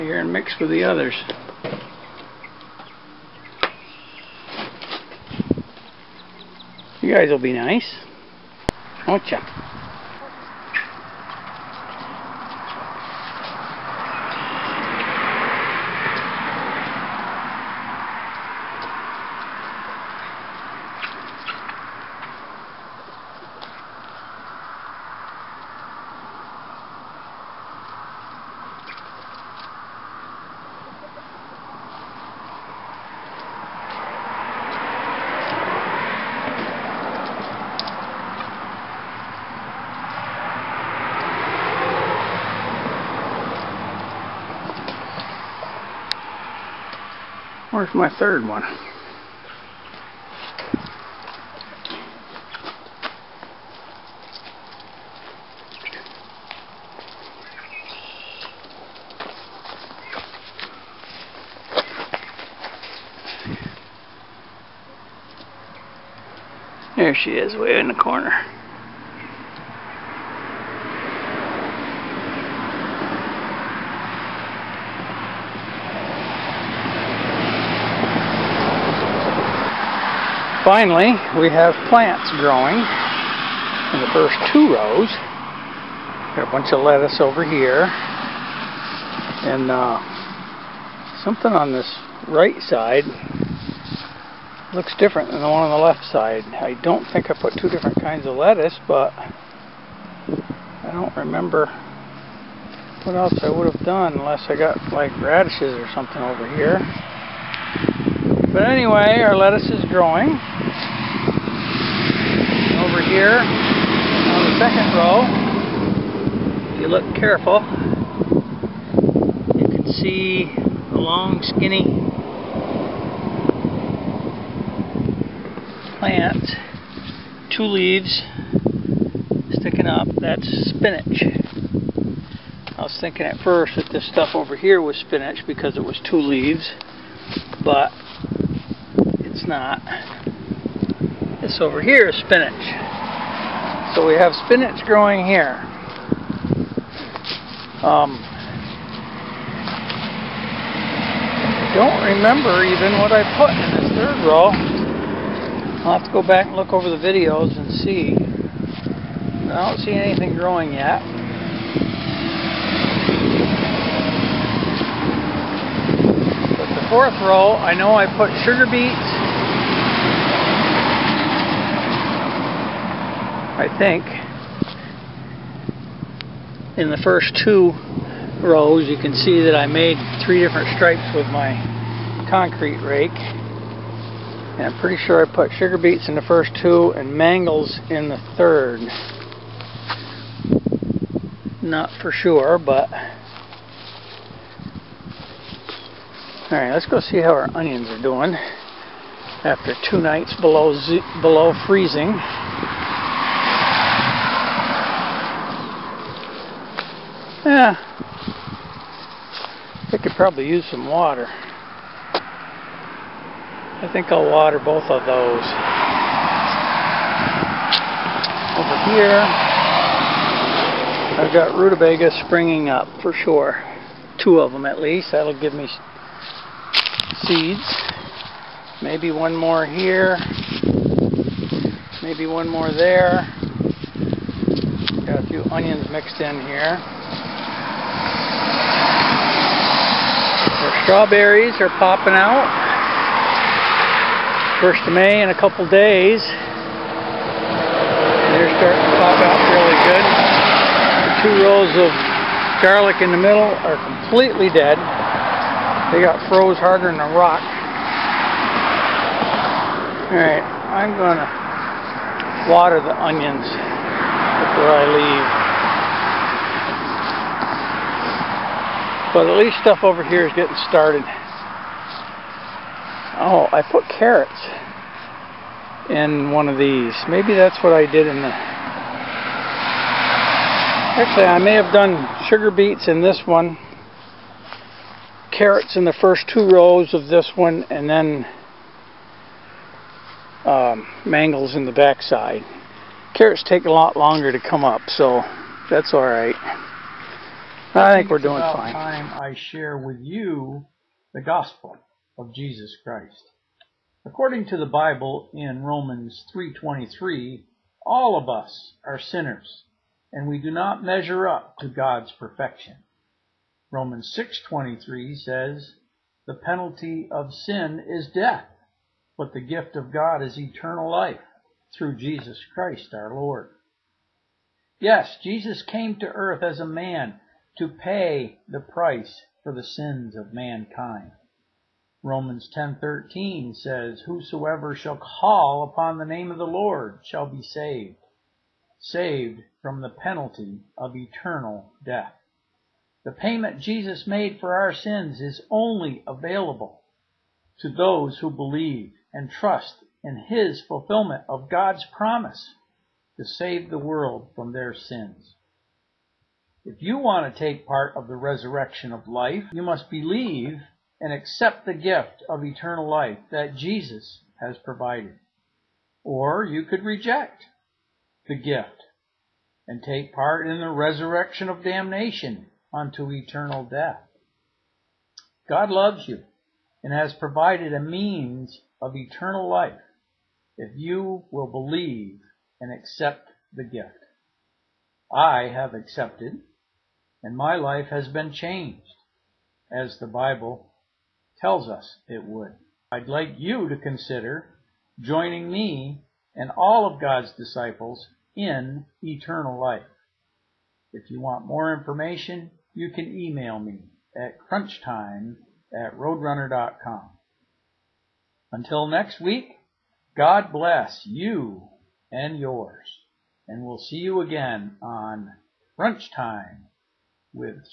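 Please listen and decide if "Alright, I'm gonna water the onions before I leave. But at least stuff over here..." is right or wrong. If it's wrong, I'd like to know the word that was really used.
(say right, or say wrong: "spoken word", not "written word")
right.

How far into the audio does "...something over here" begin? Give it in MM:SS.
01:45.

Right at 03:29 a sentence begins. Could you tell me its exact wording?
I could probably use some water.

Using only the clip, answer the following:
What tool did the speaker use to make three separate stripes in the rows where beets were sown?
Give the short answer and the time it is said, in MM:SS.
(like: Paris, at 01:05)
concrete rake, at 03:02.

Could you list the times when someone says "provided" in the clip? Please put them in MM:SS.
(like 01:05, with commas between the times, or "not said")
06:04, 06:17.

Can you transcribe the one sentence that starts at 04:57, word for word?
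I think we're doing about fine.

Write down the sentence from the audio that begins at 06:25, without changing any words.
I have accepted and my life has been changed, as the Bible tells us it would.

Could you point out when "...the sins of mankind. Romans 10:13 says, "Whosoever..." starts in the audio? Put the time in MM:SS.
05:29.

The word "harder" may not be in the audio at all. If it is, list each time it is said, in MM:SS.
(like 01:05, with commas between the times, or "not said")
04:16.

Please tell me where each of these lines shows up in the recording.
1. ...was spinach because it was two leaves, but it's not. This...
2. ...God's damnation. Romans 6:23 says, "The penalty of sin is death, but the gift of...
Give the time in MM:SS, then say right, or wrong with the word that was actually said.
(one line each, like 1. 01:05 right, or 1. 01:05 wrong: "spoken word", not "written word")
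1. 02:14 right
2. 05:11 wrong: "perfection", not "damnation".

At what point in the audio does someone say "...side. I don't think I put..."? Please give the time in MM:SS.
01:36.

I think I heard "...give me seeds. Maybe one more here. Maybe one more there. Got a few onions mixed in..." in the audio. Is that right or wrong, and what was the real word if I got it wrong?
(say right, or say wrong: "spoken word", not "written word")
right.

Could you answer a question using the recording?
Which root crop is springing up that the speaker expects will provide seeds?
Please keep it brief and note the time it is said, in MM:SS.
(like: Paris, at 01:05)
Rutabaga, at 03:41.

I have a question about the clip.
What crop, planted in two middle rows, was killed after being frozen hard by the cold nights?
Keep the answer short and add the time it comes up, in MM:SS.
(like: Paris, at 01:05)
Garlic, at 04:12.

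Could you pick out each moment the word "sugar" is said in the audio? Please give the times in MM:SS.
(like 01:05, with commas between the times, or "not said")
02:48, 03:05, 04:42.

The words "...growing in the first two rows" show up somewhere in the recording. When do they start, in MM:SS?
01:22.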